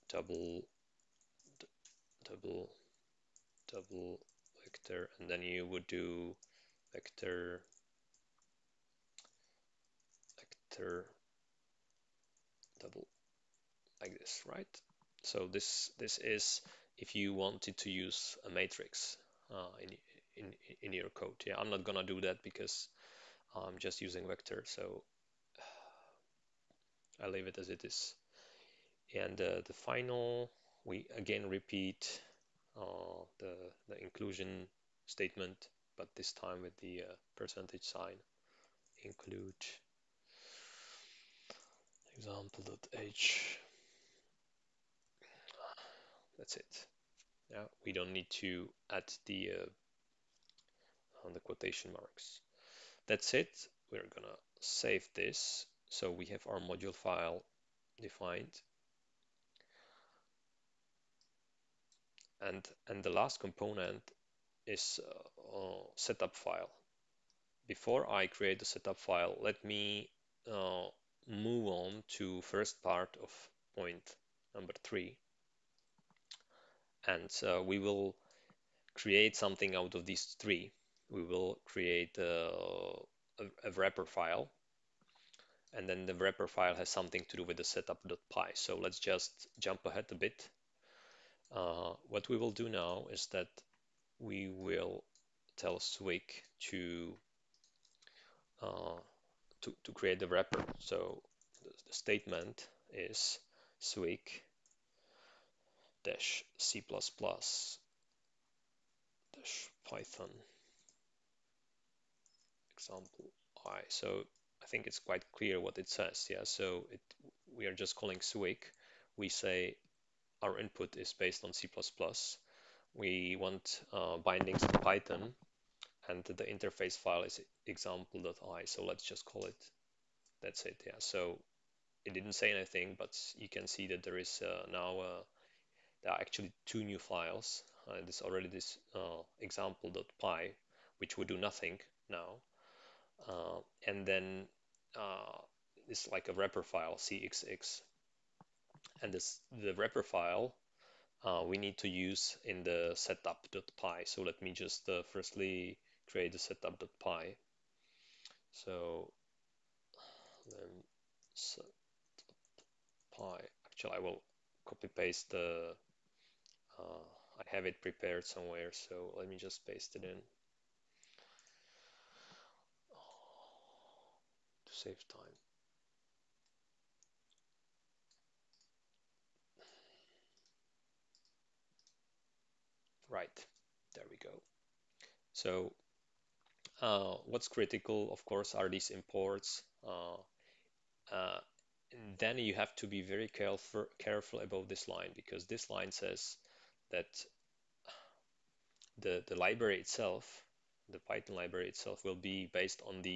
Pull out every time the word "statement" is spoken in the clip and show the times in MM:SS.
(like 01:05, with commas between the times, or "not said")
00:35, 01:41.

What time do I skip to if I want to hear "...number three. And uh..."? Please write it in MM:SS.
01:14.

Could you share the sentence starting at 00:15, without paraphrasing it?
So this this is if you wanted to use a matrix uh, in, in in your code.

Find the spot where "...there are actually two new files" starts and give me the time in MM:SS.
02:16.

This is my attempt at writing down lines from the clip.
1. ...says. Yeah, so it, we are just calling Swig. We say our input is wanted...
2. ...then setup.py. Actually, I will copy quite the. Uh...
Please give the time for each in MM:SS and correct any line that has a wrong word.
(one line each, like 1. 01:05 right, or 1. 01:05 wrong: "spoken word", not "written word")
1. 01:55 wrong: "based", not "wanted"
2. 02:40 wrong: "paste", not "quite".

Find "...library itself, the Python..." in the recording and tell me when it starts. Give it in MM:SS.
03:19.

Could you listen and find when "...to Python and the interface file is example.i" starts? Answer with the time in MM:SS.
02:04.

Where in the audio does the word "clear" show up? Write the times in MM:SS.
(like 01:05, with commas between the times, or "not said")
01:55.